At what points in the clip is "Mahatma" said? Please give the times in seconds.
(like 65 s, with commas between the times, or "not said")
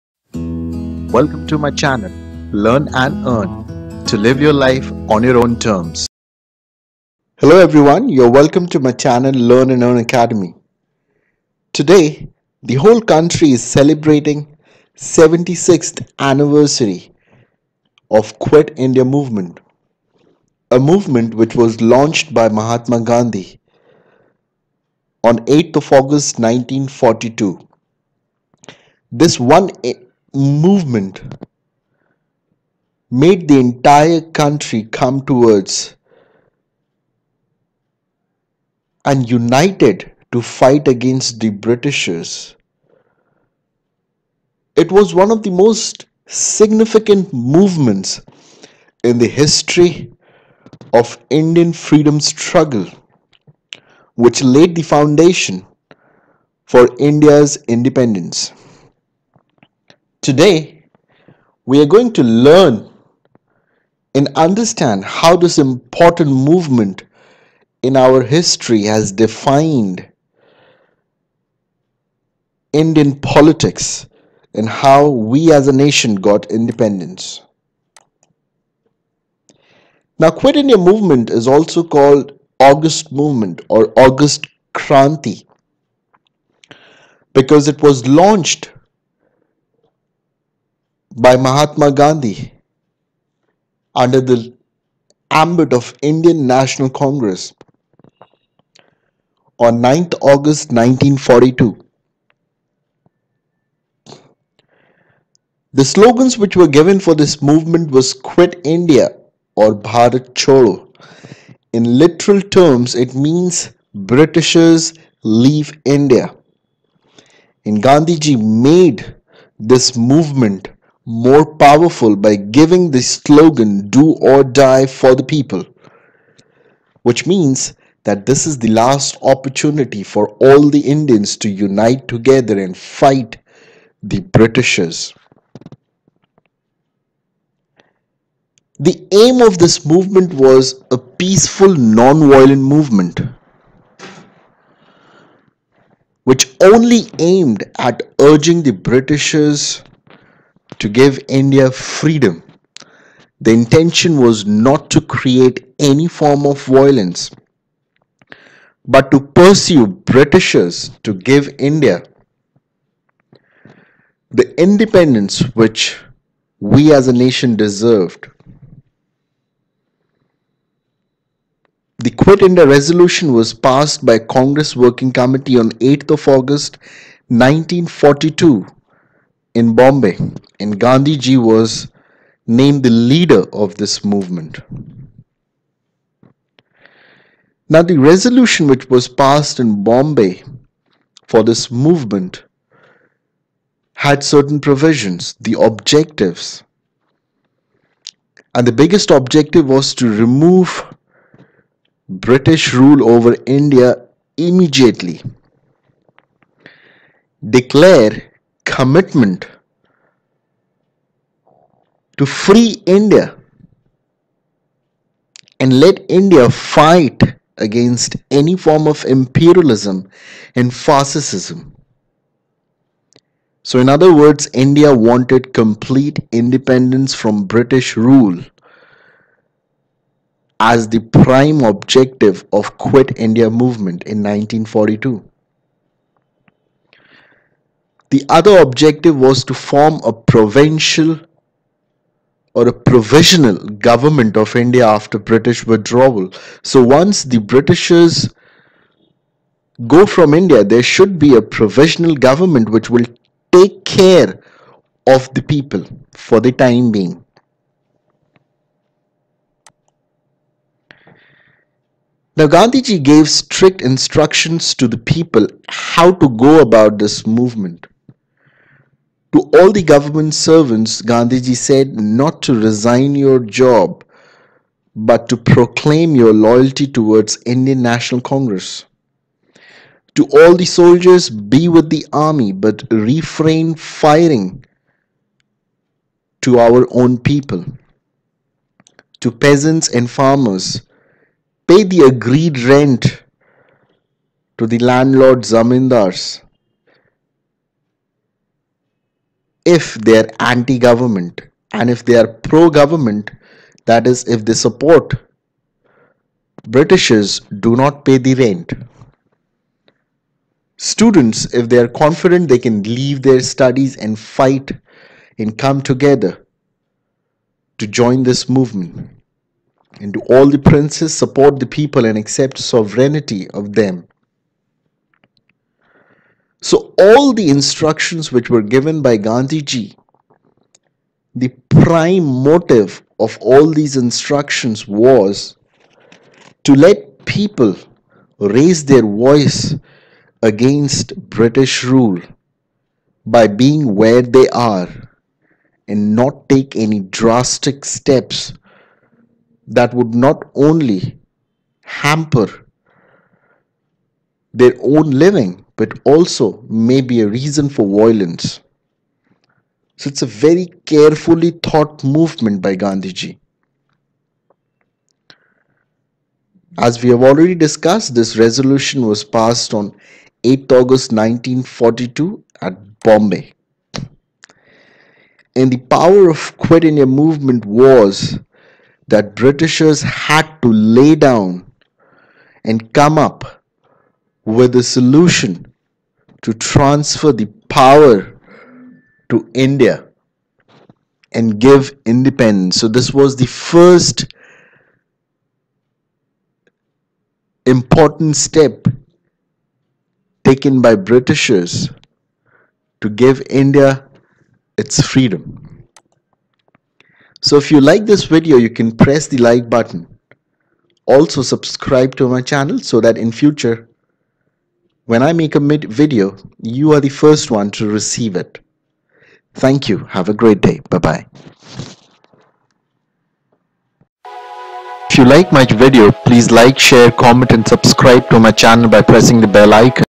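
22 s, 91 s.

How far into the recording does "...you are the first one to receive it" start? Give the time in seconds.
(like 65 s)
416 s.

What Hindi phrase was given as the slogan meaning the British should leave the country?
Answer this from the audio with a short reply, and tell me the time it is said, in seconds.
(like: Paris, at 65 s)
Bharat Chodo, at 109 s.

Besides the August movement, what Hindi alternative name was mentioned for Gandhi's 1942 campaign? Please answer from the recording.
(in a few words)
August Kranti.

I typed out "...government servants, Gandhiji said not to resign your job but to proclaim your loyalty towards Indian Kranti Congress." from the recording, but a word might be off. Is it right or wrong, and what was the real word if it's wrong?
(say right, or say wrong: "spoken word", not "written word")
wrong: "National", not "Kranti".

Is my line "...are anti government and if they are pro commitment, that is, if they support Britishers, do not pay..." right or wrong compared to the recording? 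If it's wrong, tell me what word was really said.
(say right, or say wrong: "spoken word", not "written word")
wrong: "government", not "commitment".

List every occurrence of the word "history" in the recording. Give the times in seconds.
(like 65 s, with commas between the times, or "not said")
49 s, 68 s.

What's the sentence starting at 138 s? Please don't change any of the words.
The aim of this movement was a peaceful, non violent movement, which only aimed at urging the Britishers to give India freedom.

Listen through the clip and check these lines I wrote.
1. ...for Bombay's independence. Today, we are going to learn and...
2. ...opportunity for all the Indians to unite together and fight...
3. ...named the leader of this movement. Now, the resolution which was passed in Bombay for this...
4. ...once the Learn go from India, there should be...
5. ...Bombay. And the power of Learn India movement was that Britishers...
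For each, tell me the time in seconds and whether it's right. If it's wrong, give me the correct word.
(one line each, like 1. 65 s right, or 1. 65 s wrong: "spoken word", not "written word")
1. 56 s wrong: "India", not "Bombay"
2. 129 s right
3. 182 s right
4. 246 s wrong: "Britishers", not "Learn"
5. 373 s wrong: "Quit", not "Learn".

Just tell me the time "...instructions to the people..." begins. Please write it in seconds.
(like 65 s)
263 s.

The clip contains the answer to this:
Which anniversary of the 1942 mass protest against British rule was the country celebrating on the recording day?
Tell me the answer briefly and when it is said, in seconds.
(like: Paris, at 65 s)
76th, at 14 s.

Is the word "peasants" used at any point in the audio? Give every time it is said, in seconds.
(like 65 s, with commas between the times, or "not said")
289 s.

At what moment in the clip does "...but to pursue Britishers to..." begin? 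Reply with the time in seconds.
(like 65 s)
158 s.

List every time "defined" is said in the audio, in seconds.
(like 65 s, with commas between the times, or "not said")
69 s.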